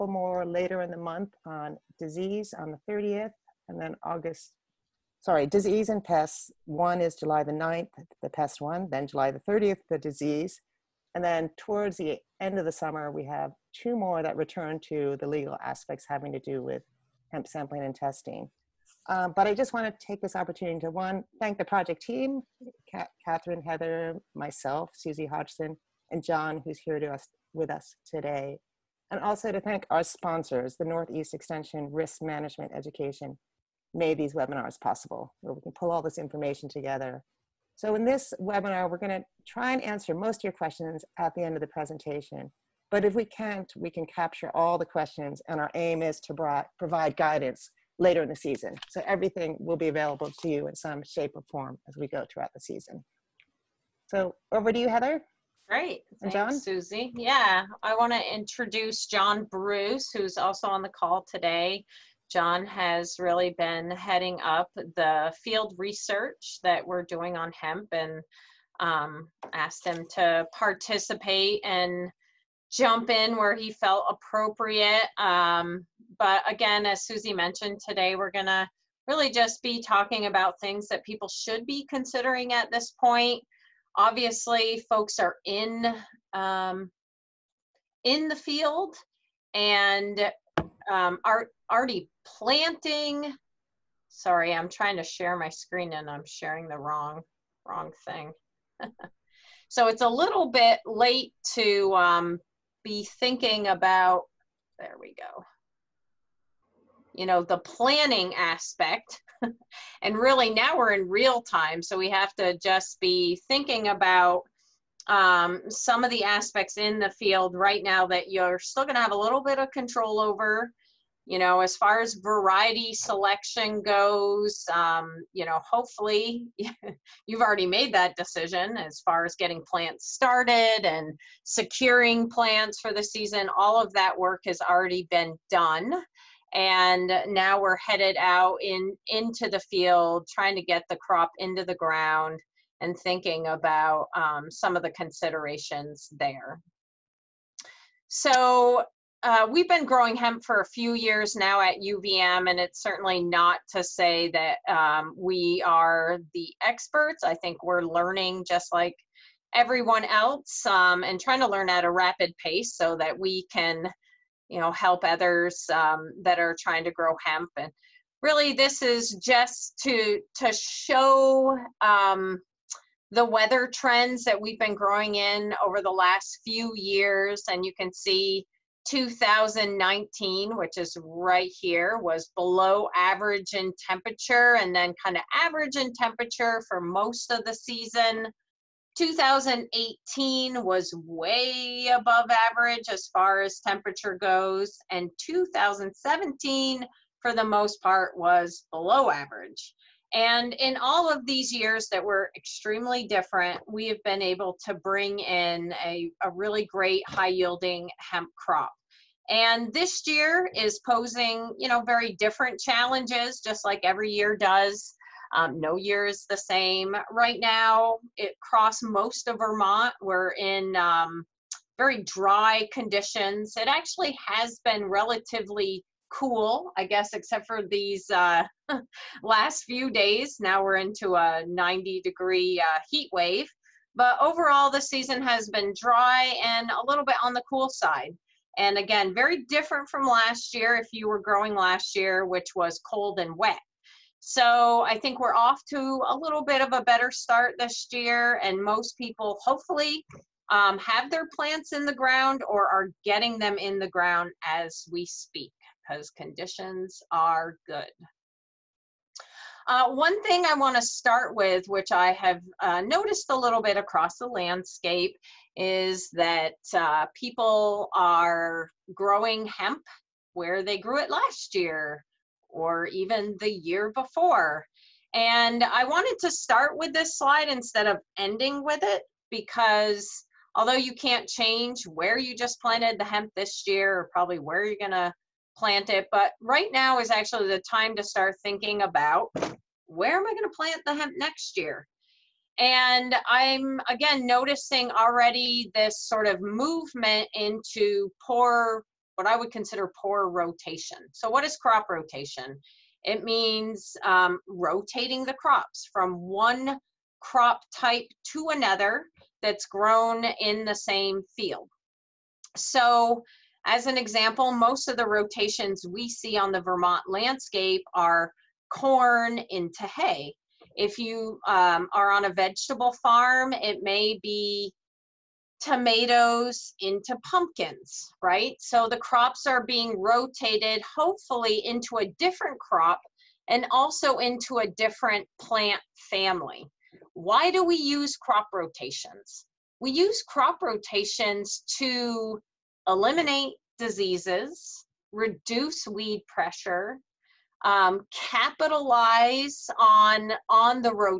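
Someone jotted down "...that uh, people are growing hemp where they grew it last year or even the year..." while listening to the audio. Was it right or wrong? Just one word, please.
right.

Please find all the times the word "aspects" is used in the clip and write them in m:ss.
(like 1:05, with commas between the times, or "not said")
0:15, 1:48, 1:56.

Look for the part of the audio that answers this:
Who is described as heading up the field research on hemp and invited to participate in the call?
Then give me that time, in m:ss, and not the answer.
0:59.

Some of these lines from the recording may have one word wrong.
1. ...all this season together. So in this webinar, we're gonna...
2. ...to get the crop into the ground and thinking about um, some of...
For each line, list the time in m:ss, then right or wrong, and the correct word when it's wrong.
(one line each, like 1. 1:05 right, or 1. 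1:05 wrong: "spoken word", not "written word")
1. 0:35 wrong: "information", not "season"
2. 2:20 right.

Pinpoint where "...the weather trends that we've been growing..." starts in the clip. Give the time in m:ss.
2:53.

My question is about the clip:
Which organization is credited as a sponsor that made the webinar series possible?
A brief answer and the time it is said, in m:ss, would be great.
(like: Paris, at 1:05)
Northeast Extension Risk Management Education, at 0:30.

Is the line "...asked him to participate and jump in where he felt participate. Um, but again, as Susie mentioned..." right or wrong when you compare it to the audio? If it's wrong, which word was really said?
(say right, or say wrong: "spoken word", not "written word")
wrong: "appropriate", not "participate".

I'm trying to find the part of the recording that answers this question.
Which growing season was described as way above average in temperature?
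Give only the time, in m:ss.
3:08.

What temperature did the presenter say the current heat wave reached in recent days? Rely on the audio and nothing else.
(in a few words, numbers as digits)
90 degrees.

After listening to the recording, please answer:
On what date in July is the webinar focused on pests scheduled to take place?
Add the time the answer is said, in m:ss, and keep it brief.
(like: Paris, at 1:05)
July 9, at 0:07.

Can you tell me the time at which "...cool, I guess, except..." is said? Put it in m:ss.
3:46.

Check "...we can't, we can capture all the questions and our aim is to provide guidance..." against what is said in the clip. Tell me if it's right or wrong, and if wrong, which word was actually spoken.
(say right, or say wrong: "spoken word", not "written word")
right.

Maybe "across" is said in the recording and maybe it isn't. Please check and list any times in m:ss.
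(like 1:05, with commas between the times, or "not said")
4:23.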